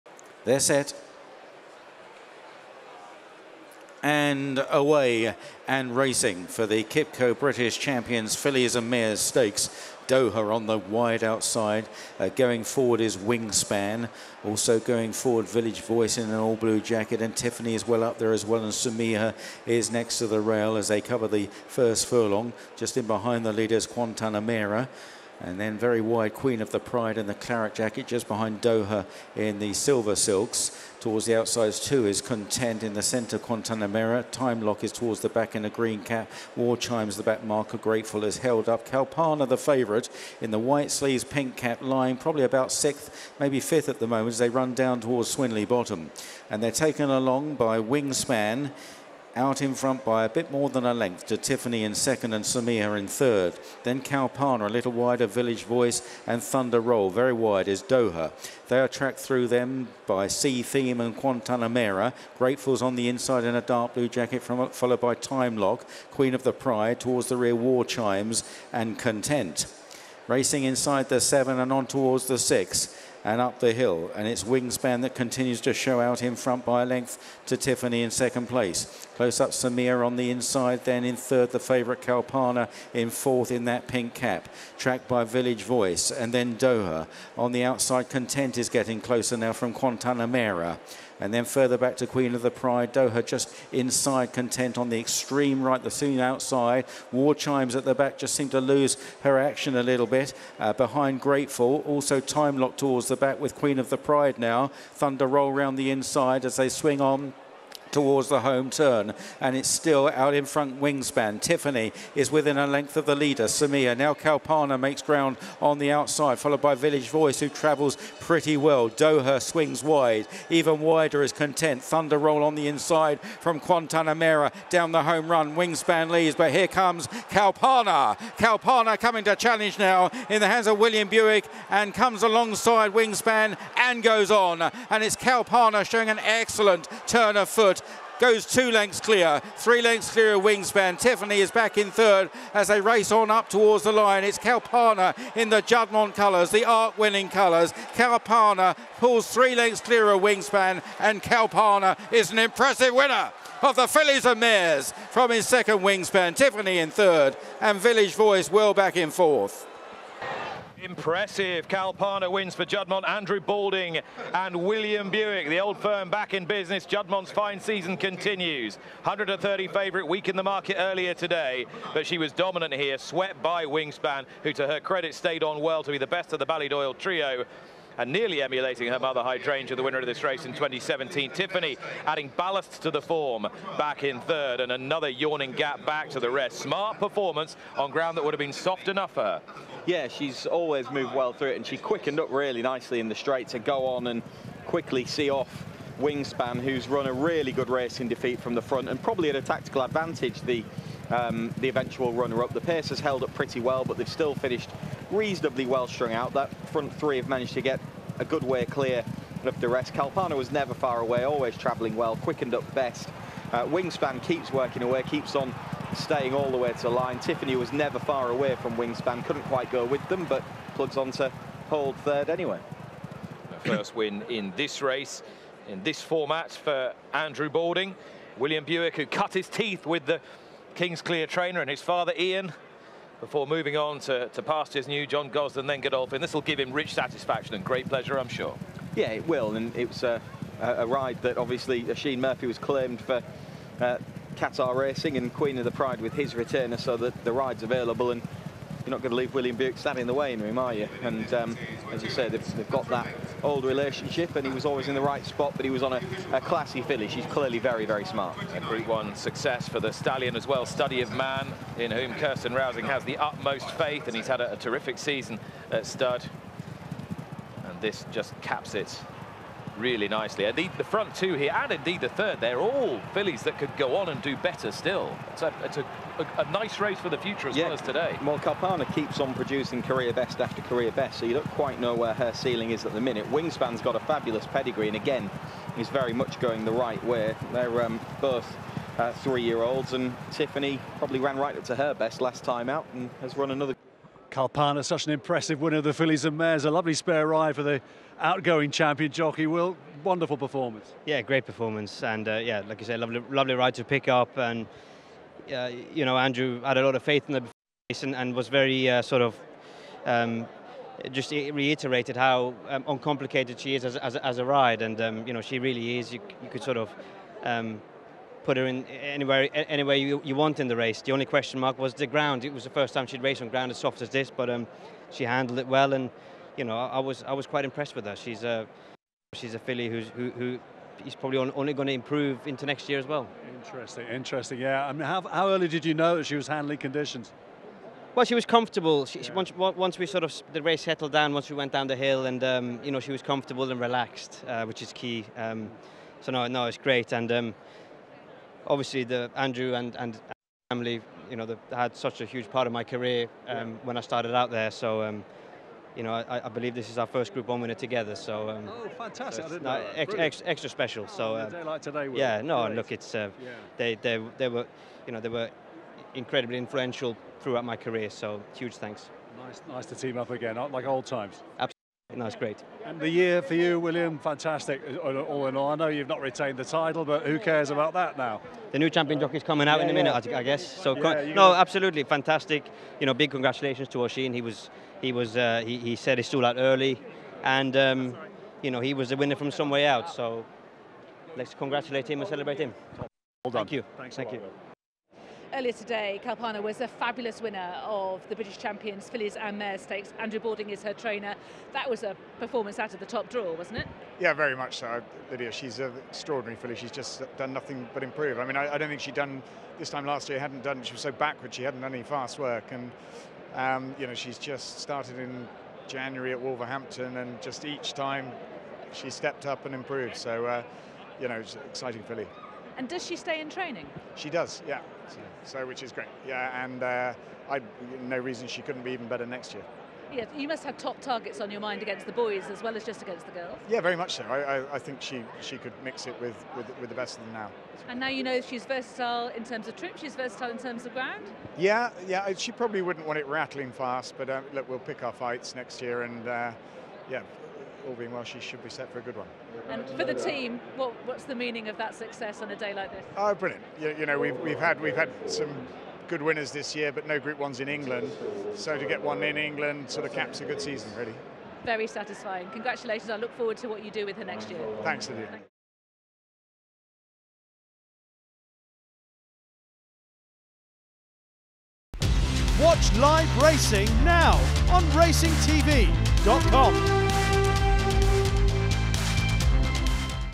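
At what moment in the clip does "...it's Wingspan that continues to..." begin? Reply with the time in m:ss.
1:14.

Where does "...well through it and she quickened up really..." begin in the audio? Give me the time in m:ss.
3:11.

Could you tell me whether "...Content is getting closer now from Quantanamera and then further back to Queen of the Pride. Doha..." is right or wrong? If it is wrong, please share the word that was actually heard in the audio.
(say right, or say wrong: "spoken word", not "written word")
right.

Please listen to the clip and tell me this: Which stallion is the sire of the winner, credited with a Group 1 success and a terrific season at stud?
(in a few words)
Study of Man.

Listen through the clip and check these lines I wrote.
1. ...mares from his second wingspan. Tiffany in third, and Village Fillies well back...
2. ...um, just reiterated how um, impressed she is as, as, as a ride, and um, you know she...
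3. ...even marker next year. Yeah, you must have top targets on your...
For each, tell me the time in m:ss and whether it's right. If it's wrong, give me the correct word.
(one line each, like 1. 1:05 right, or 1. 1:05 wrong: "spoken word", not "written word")
1. 2:34 wrong: "Voice", not "Fillies"
2. 5:10 wrong: "uncomplicated", not "impressed"
3. 7:08 wrong: "better", not "marker".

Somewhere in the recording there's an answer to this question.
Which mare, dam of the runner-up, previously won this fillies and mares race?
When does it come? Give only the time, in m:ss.
2:59.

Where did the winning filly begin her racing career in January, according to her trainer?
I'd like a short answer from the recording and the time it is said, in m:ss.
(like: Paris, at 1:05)
Wolverhampton, at 6:56.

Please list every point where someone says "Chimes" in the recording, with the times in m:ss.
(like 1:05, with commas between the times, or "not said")
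0:36, 1:07, 1:37.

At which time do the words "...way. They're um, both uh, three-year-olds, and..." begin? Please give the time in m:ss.
4:47.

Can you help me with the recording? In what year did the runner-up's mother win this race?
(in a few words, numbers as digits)
2017.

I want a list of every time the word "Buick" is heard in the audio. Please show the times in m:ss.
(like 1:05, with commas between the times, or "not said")
2:11, 2:45, 3:48, 4:09.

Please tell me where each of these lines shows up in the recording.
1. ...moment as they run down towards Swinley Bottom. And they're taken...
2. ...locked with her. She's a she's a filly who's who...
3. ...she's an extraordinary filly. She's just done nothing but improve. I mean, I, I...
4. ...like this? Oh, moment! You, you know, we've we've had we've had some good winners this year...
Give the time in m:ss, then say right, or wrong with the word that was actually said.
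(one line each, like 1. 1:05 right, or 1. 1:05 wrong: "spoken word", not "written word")
1. 0:44 right
2. 5:27 wrong: "impressed", not "locked"
3. 6:45 right
4. 7:32 wrong: "brilliant", not "moment".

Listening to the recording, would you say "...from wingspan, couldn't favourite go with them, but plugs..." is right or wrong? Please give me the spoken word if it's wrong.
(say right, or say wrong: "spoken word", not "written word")
wrong: "quite", not "favourite".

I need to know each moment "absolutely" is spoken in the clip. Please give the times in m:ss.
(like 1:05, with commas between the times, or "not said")
6:11, 6:21.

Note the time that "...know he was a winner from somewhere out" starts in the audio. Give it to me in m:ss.
6:28.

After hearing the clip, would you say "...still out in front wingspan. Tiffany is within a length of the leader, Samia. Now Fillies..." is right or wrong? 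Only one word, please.
wrong.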